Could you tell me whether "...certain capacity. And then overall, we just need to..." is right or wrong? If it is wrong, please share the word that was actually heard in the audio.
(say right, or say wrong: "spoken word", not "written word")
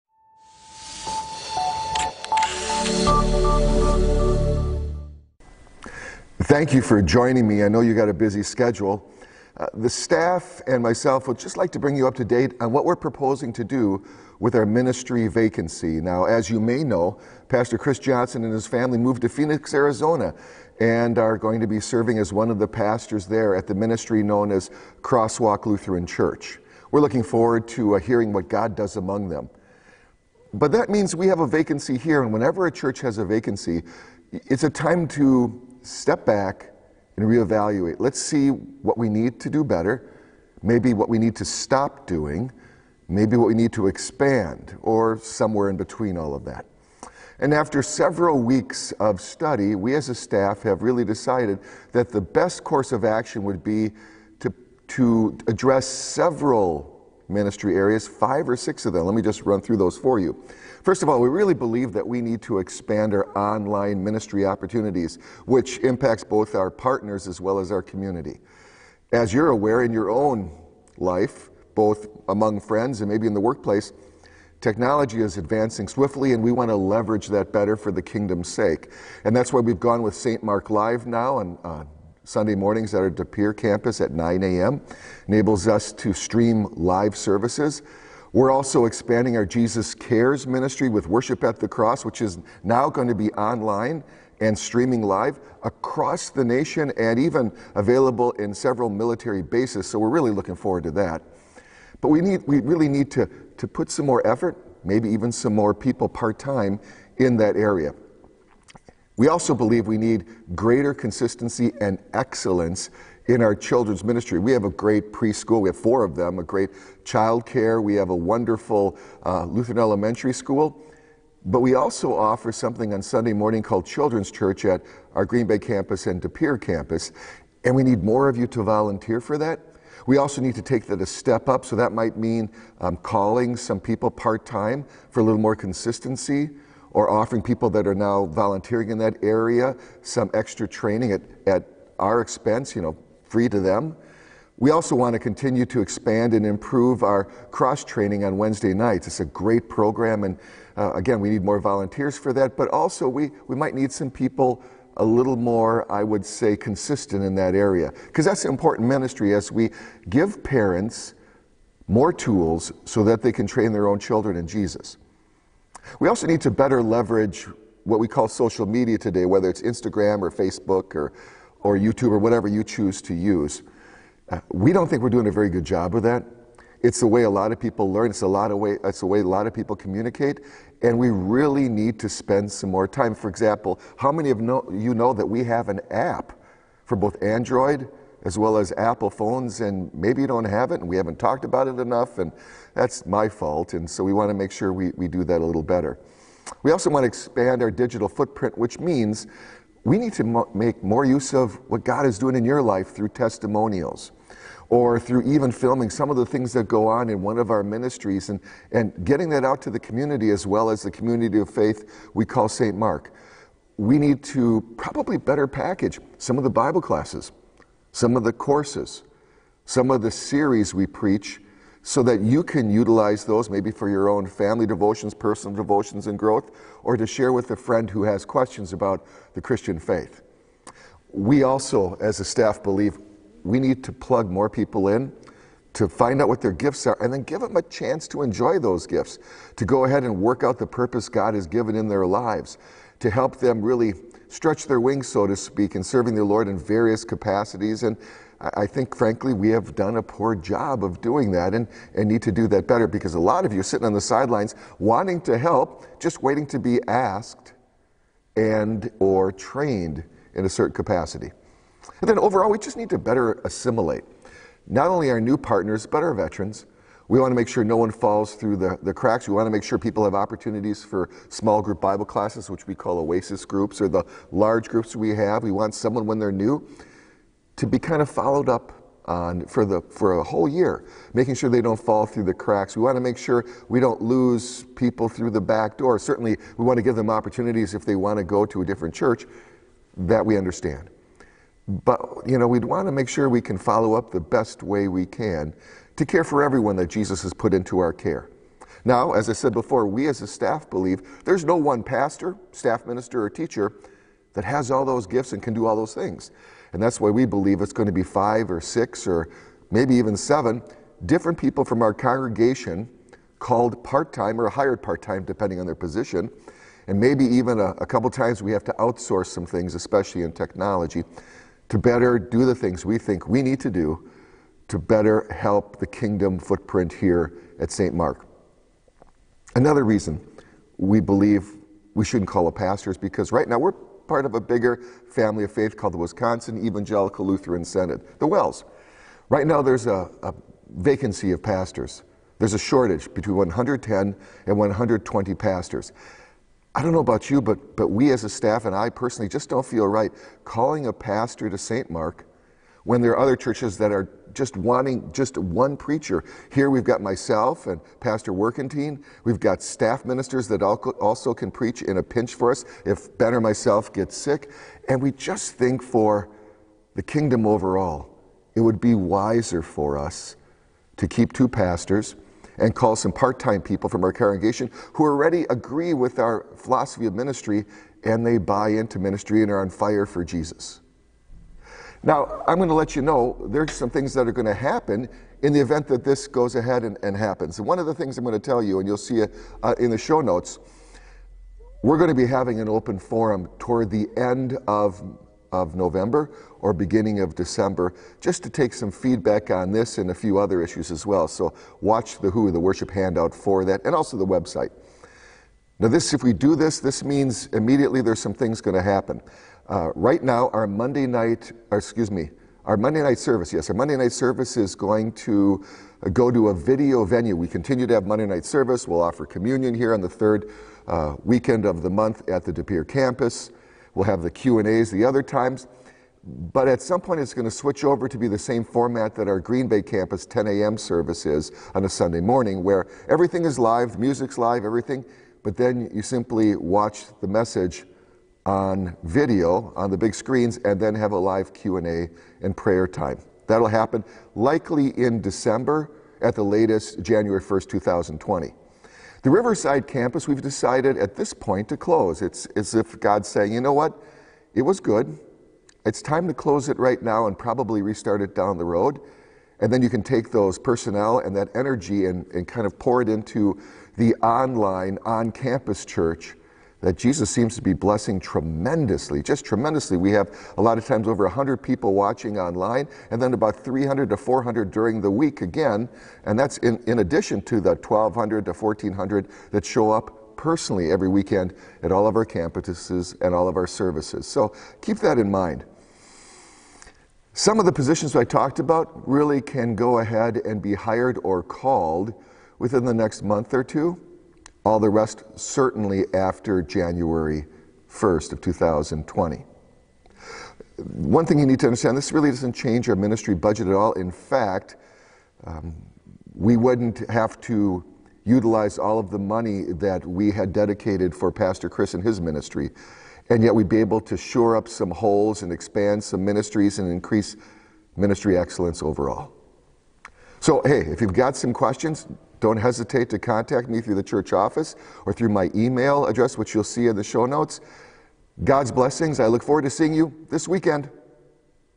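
right.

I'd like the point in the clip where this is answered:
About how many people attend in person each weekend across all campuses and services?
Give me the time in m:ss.
7:57.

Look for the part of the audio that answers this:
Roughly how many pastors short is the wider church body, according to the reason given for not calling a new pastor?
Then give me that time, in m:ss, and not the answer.
5:43.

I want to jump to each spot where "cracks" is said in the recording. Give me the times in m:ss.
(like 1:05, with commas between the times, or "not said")
4:28, 4:42.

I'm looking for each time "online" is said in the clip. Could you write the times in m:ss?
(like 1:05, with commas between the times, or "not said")
1:03, 1:33, 7:44, 7:52.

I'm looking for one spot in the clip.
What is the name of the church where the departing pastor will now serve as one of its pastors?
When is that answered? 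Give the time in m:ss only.
0:25.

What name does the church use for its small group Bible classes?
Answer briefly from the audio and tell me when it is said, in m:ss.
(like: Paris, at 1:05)
oasis groups, at 4:32.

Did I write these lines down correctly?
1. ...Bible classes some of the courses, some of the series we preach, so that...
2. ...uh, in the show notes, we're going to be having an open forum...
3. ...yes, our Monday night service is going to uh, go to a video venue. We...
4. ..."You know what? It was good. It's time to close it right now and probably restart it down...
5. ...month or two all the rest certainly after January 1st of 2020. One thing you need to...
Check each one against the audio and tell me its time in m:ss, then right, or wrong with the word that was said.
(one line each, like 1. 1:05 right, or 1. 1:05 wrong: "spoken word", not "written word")
1. 3:36 right
2. 6:29 right
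3. 6:53 right
4. 7:33 right
5. 8:13 right.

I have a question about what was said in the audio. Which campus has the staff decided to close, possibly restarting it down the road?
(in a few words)
Riverside.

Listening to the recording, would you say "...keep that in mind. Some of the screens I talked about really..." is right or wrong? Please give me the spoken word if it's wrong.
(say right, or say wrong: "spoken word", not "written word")
wrong: "positions", not "screens".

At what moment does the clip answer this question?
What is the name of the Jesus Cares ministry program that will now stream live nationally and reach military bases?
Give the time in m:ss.
1:31.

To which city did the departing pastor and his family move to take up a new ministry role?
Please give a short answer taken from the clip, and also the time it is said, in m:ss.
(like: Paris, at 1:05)
Phoenix, Arizona, at 0:19.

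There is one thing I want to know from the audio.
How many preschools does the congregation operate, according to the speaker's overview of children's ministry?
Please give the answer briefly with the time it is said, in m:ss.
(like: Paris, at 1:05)
4, at 1:55.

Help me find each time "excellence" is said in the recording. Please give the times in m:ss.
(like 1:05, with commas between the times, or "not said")
1:52, 8:38.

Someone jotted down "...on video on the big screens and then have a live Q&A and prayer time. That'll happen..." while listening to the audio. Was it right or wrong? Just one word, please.
right.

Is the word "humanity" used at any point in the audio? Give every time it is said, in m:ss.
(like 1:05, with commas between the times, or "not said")
not said.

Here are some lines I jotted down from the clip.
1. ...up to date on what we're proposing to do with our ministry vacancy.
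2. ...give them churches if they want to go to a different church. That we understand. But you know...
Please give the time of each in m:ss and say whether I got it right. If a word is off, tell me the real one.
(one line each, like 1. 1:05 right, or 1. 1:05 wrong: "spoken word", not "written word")
1. 0:12 right
2. 4:46 wrong: "opportunities", not "churches".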